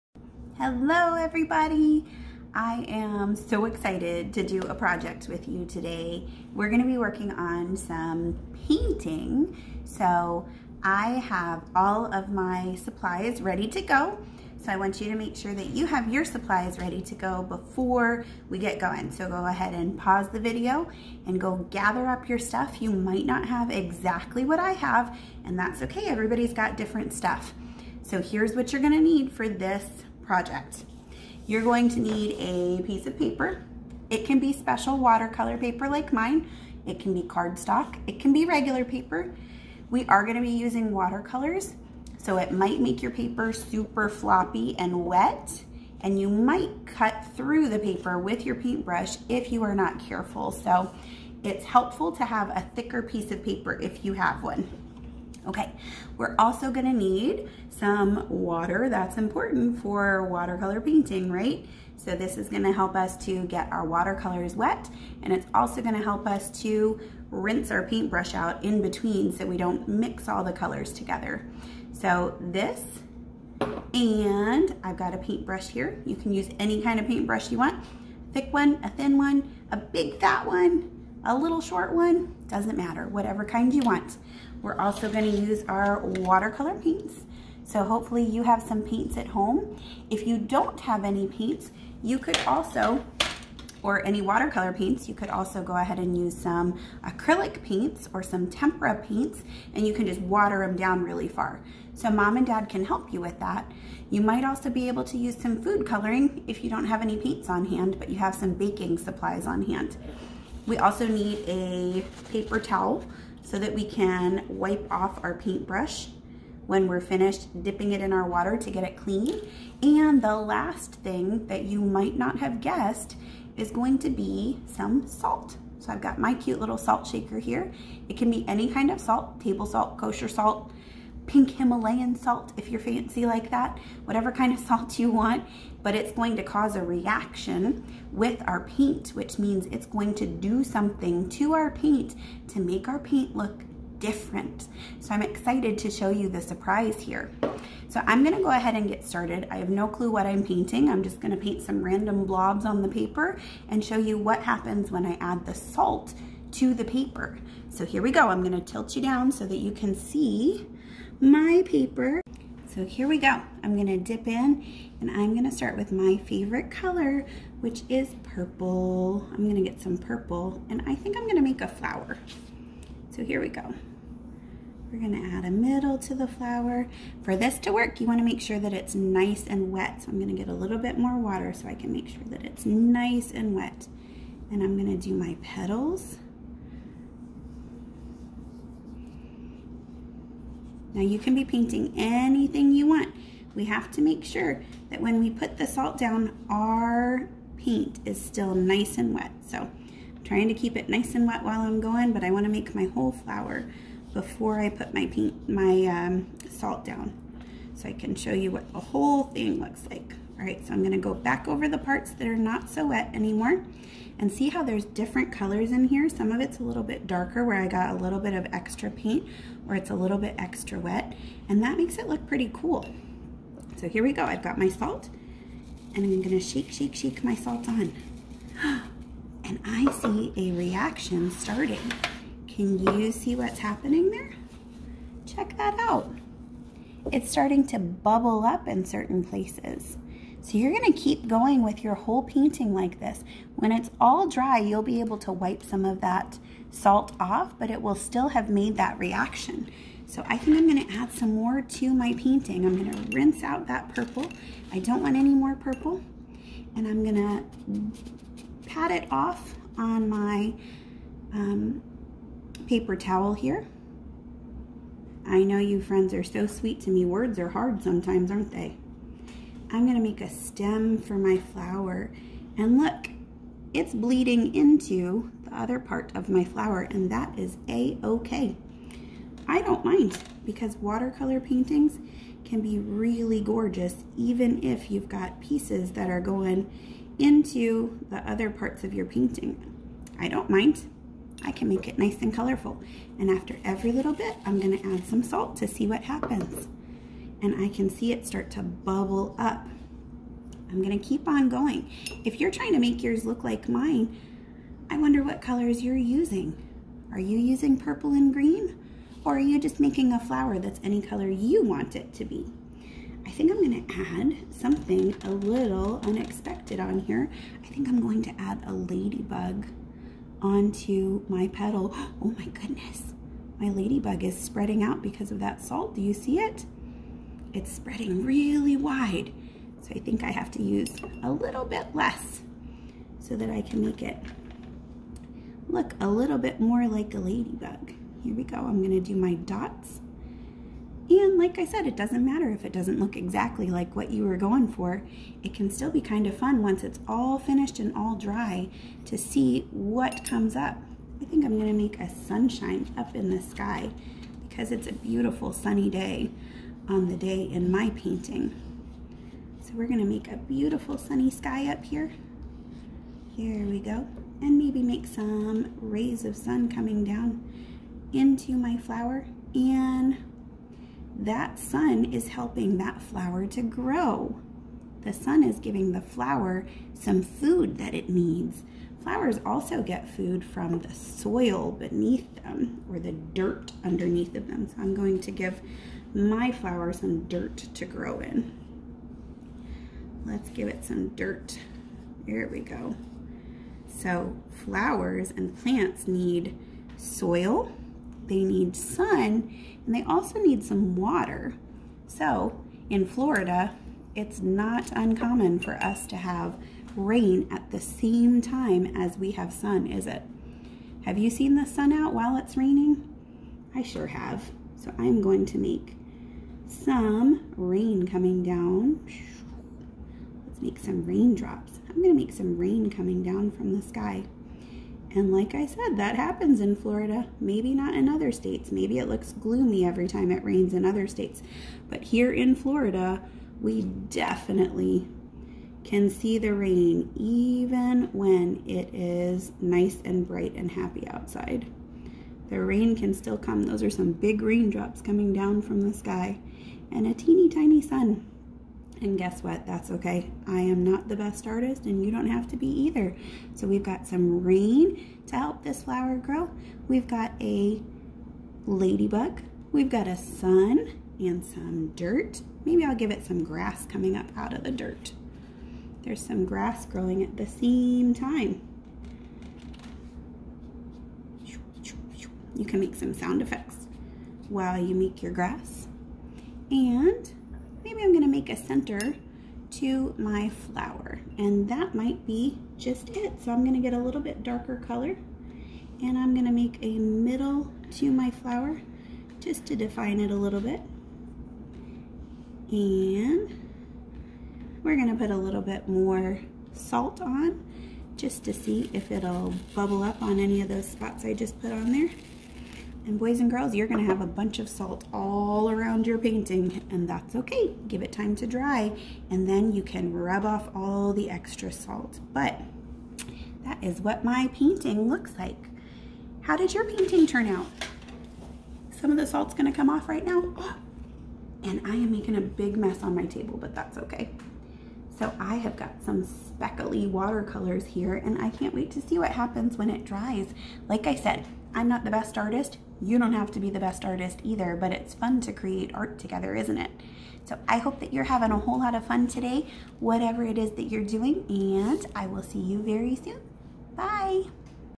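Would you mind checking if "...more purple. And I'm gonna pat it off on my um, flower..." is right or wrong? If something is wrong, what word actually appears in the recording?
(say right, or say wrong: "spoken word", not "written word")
wrong: "paper", not "flower".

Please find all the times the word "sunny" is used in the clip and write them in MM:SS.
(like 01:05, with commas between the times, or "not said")
05:55, 06:00.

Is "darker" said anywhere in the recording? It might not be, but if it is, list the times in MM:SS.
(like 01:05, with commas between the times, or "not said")
03:37, 08:04.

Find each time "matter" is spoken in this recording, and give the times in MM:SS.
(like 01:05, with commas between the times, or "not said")
01:22, 05:42.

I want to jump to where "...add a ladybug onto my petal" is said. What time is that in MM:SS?
05:18.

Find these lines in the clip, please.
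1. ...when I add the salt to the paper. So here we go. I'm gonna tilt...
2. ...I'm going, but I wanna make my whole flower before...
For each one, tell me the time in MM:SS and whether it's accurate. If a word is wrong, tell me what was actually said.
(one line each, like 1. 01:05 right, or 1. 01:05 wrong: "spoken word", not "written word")
1. 02:34 right
2. 03:21 right.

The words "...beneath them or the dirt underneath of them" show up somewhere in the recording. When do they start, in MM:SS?
06:21.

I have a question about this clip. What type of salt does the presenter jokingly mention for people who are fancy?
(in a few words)
Pink Himalayan salt.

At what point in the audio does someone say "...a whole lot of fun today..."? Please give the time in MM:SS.
08:58.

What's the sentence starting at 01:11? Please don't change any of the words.
So this, and I've got a paintbrush here.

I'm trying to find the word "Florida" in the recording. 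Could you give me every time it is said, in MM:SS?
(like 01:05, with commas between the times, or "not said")
06:43, 07:06, 07:12.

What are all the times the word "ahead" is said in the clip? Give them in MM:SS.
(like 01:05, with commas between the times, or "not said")
00:19, 01:35, 02:28.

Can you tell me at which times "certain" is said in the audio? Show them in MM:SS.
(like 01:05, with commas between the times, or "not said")
03:58.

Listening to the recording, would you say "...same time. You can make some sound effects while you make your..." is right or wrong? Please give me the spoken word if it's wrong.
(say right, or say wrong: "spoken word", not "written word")
right.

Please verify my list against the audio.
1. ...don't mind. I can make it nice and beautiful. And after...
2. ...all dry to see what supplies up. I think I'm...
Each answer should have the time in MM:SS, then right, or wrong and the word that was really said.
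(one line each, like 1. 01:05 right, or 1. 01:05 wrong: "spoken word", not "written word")
1. 04:50 wrong: "colorful", not "beautiful"
2. 05:47 wrong: "comes", not "supplies".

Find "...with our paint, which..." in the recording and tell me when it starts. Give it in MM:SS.
02:18.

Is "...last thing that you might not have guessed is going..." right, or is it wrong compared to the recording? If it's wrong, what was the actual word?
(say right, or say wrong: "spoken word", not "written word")
right.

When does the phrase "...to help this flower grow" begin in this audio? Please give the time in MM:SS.
07:35.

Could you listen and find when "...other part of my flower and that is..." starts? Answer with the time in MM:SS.
04:35.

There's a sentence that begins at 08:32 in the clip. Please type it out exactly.
But that is what my painting looks like.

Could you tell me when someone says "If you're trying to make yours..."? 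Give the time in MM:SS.
05:02.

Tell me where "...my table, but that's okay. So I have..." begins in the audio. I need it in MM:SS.
08:43.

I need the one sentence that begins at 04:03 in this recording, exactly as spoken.
When it's all dry, you'll be able to wipe some of that salt off, but it will still have made that reaction.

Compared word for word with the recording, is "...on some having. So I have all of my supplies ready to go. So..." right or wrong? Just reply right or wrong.
wrong.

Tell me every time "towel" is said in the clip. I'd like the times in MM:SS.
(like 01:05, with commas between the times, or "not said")
01:52, 04:22.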